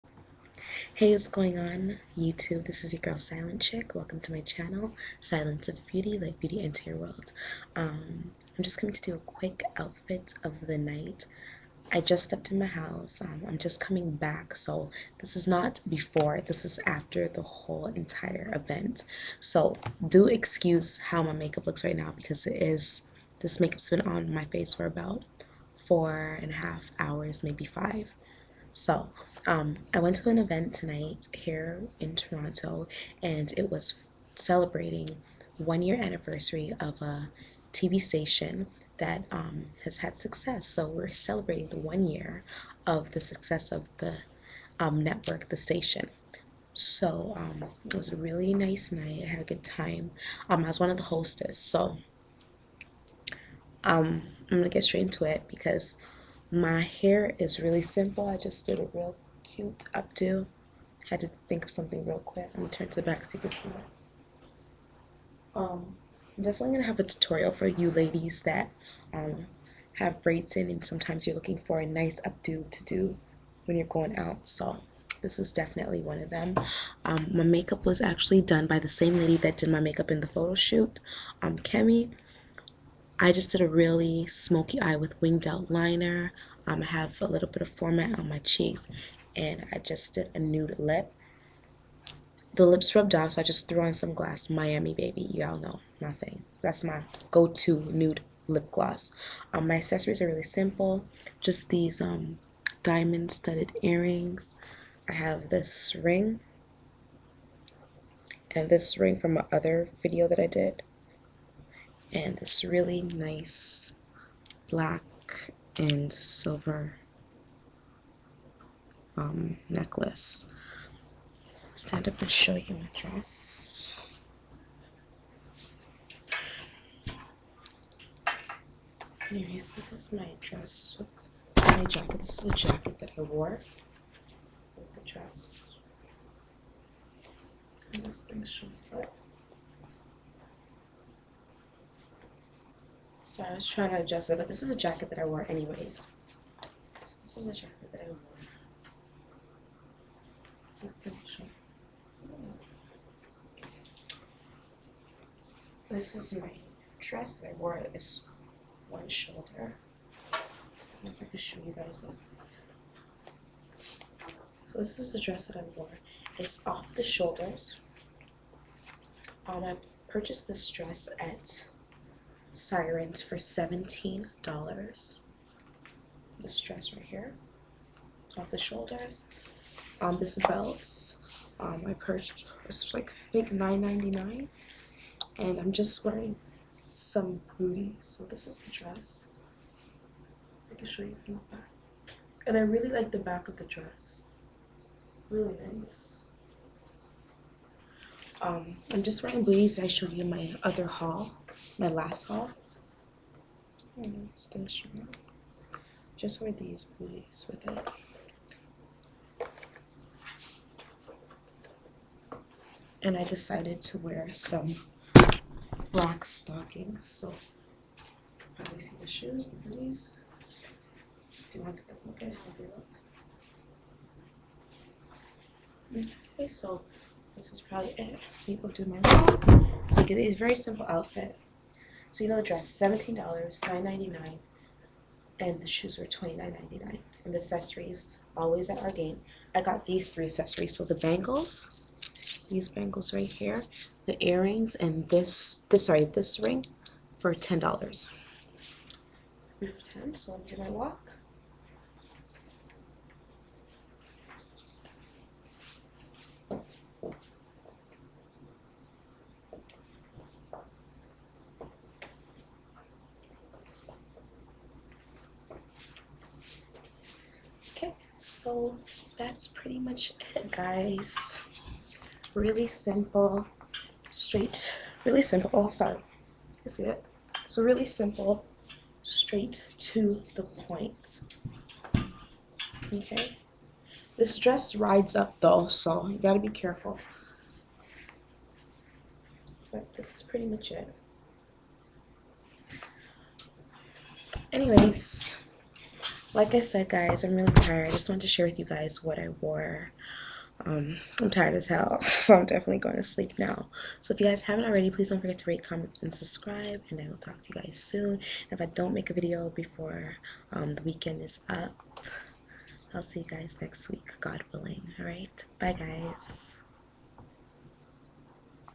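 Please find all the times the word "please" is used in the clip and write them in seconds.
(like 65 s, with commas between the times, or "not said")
304 s.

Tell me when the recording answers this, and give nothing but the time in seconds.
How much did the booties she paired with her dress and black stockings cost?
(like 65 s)
236 s.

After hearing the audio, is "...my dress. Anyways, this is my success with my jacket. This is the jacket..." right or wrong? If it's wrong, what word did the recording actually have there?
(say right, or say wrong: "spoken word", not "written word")
wrong: "dress", not "success".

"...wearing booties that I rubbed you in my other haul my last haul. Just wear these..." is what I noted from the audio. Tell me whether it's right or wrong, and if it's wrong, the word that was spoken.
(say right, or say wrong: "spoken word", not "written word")
wrong: "showed", not "rubbed".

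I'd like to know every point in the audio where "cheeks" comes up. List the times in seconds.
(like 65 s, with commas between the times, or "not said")
88 s.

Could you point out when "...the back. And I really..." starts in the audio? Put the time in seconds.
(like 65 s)
191 s.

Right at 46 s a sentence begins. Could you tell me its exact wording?
So um, it was a really nice night.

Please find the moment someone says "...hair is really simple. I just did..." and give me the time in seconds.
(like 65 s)
56 s.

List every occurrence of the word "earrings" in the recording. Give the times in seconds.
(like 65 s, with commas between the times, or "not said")
103 s, 244 s.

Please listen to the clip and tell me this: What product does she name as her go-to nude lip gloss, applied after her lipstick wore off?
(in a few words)
Miami Baby.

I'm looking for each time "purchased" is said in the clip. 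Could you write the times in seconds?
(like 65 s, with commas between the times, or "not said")
170 s, 181 s.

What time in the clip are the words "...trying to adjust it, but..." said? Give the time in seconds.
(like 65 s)
143 s.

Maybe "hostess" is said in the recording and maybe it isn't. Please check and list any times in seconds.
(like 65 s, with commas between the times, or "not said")
51 s.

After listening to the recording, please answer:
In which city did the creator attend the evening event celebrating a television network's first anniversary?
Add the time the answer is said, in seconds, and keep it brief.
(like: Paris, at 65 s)
Toronto, at 32 s.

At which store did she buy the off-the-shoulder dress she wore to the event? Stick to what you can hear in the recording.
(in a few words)
Siren's.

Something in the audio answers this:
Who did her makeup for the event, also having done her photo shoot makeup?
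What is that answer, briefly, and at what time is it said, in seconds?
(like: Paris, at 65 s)
Kemi, at 81 s.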